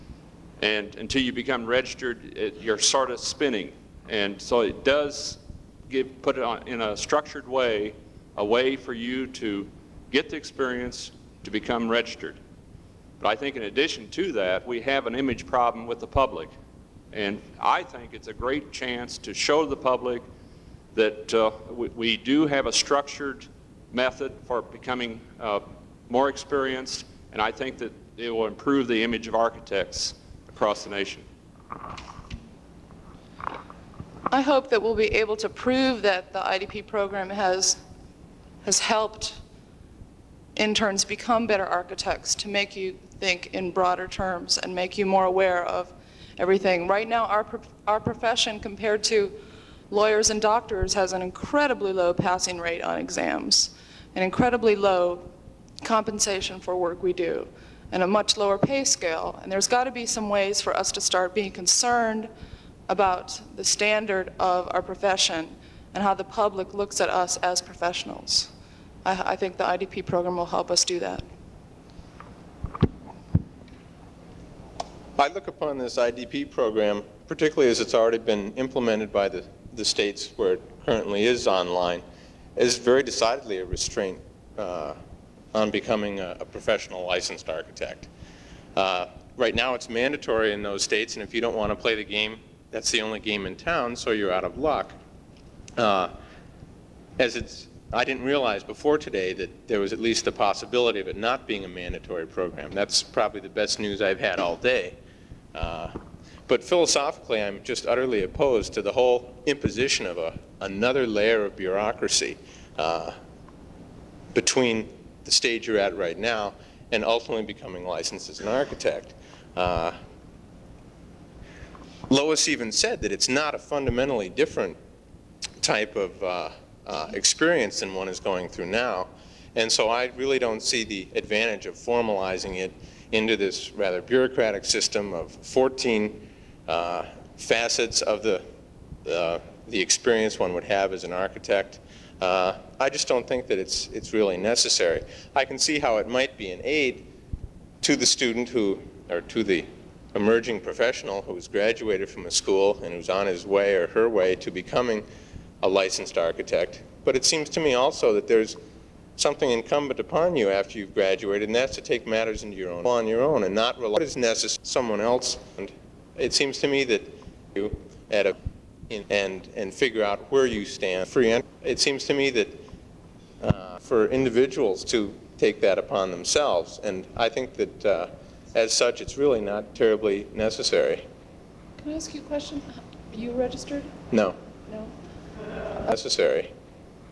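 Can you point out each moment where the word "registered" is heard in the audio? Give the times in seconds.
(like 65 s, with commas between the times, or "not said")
1 s, 11 s, 183 s.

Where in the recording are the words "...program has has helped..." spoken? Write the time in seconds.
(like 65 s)
36 s.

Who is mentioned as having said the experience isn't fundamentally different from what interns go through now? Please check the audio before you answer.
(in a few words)
Lois.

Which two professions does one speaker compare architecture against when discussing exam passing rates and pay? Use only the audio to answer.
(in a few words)
Lawyers and doctors.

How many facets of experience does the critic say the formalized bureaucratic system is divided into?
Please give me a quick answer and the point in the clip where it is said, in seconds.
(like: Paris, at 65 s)
14, at 135 s.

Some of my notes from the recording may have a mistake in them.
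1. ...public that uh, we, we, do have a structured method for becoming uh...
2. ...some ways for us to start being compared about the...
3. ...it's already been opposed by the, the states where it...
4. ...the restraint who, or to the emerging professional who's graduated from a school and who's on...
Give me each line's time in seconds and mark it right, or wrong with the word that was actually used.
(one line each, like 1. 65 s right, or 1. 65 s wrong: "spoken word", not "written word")
1. 19 s right
2. 60 s wrong: "concerned", not "compared"
3. 77 s wrong: "implemented", not "opposed"
4. 147 s wrong: "student", not "restraint".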